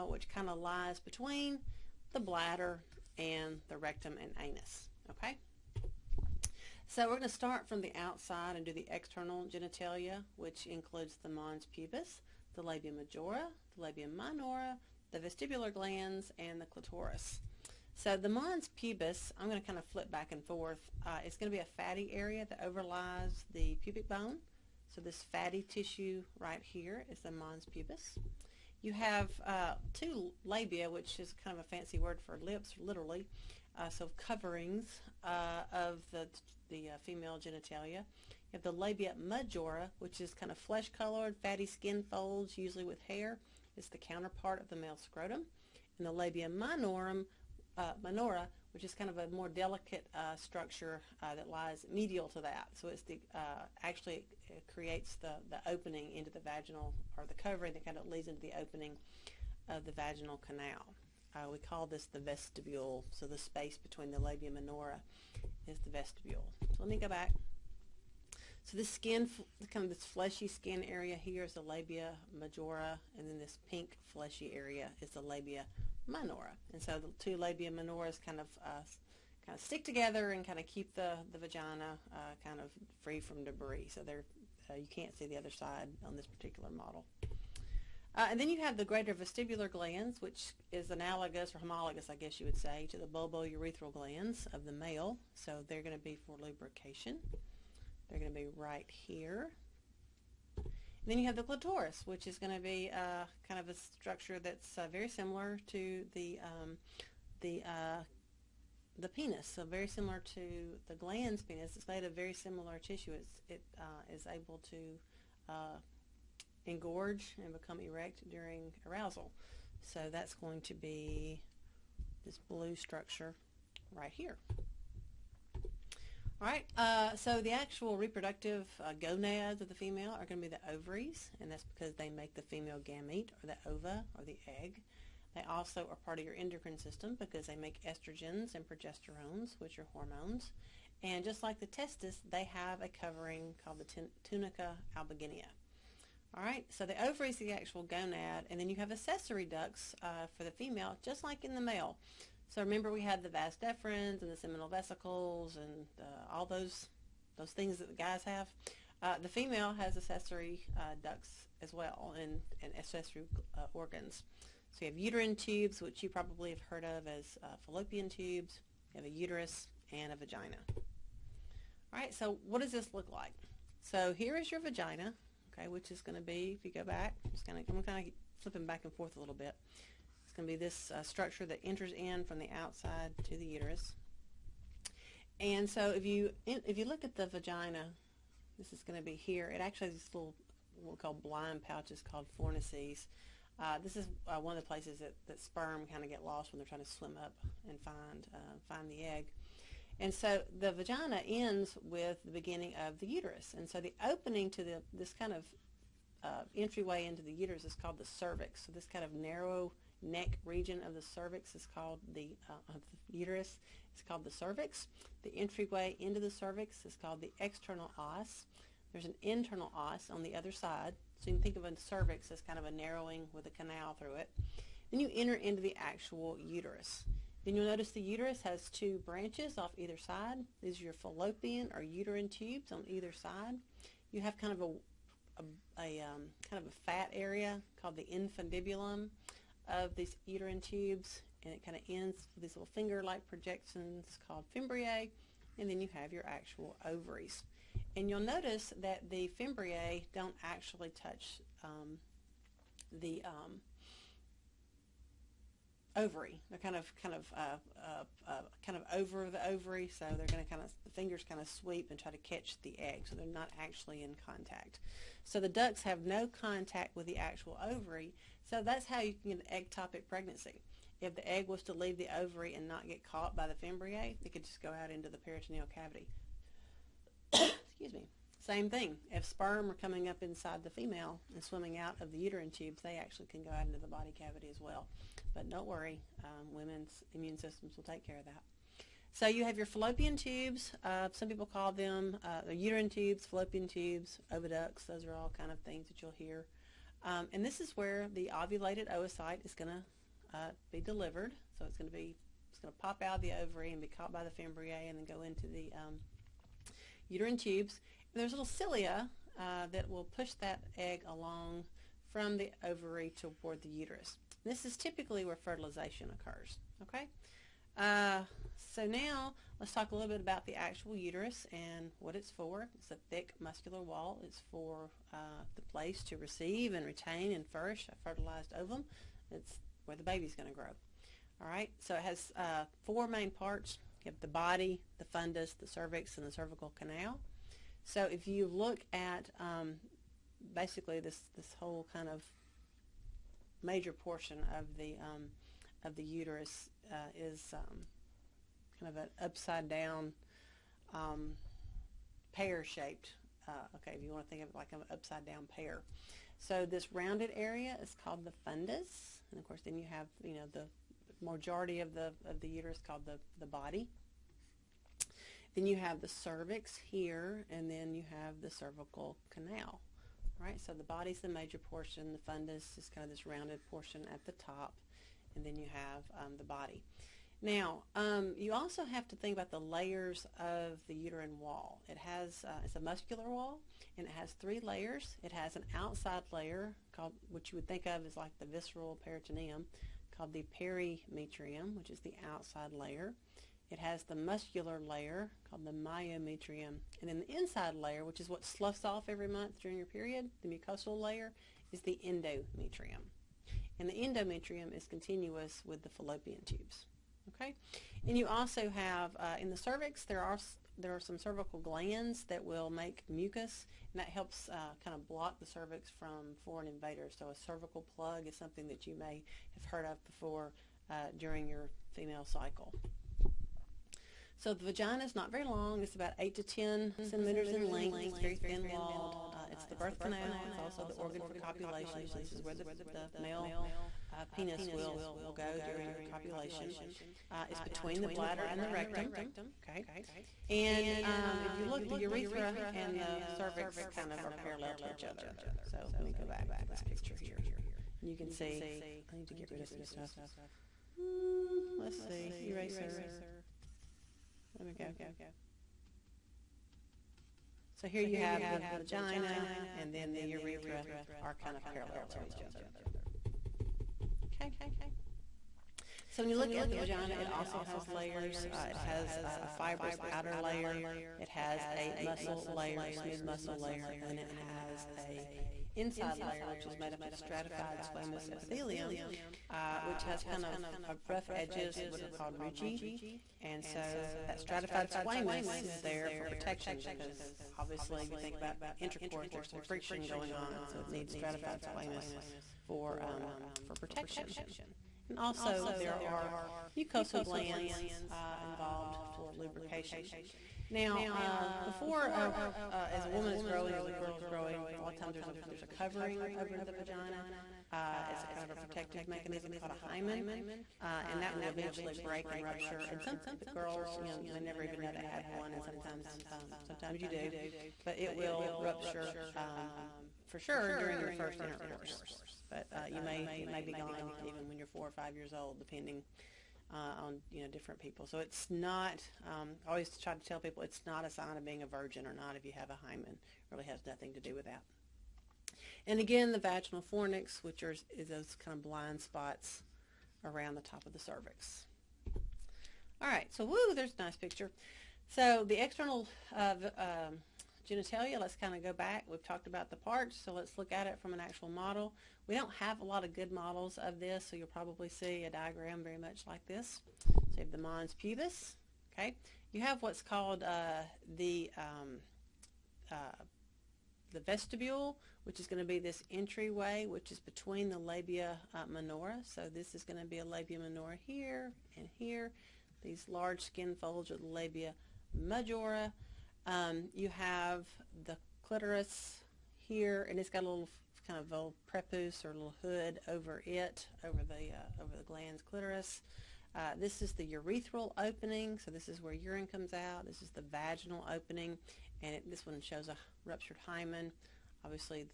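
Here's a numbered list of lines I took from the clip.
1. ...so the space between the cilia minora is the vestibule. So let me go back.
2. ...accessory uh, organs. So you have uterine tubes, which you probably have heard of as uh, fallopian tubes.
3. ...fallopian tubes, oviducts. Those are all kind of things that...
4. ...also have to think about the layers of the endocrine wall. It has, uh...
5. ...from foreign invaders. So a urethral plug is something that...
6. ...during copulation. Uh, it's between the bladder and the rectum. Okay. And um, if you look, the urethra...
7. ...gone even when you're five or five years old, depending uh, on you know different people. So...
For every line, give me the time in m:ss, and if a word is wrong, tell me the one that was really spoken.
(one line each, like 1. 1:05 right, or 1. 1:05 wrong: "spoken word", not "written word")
1. 1:03 wrong: "labia", not "cilia"
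2. 2:42 right
3. 4:53 right
4. 6:18 wrong: "uterine", not "endocrine"
5. 6:55 wrong: "cervical", not "urethral"
6. 7:15 right
7. 8:43 wrong: "four", not "five".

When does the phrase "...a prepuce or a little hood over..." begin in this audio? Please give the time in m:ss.
9:41.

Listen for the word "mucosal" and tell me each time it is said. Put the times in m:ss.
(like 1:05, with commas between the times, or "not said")
6:40, 8:16.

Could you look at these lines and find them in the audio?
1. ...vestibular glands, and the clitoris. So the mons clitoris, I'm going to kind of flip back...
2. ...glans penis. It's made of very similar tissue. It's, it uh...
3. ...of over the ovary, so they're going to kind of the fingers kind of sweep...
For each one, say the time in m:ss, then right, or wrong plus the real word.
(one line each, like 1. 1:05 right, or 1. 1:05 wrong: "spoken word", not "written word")
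1. 0:15 wrong: "pubis", not "clitoris"
2. 1:50 right
3. 4:18 right.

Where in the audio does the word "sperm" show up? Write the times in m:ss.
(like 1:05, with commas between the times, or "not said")
3:15, 4:39.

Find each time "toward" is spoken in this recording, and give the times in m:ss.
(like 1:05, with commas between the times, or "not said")
5:13.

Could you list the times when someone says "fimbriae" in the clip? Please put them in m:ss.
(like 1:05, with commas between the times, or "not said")
4:04, 4:09, 4:33, 5:04.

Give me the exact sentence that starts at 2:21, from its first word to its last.
And just like the testis, they have a covering called the tunica albuginea.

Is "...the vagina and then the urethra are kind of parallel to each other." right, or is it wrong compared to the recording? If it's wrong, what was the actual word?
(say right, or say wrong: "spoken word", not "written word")
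right.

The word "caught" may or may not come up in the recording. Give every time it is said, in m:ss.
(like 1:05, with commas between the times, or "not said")
4:33, 5:03.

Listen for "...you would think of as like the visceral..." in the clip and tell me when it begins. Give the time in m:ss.
6:27.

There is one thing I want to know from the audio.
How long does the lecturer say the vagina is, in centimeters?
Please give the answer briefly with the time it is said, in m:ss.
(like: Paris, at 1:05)
8 to 10 centimeters, at 7:06.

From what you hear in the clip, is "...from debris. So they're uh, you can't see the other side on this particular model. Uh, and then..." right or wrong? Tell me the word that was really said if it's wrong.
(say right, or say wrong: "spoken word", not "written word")
right.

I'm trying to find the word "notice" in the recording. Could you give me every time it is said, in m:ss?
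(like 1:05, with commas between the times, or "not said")
3:47, 4:08.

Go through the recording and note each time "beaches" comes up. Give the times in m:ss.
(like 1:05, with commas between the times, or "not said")
not said.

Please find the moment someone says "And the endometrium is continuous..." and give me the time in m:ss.
6:43.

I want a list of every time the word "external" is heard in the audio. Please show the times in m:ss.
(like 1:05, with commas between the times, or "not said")
0:08, 3:37, 9:05.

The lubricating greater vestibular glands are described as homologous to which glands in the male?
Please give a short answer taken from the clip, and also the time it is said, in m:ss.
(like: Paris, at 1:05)
Bulbourethral glands, at 1:33.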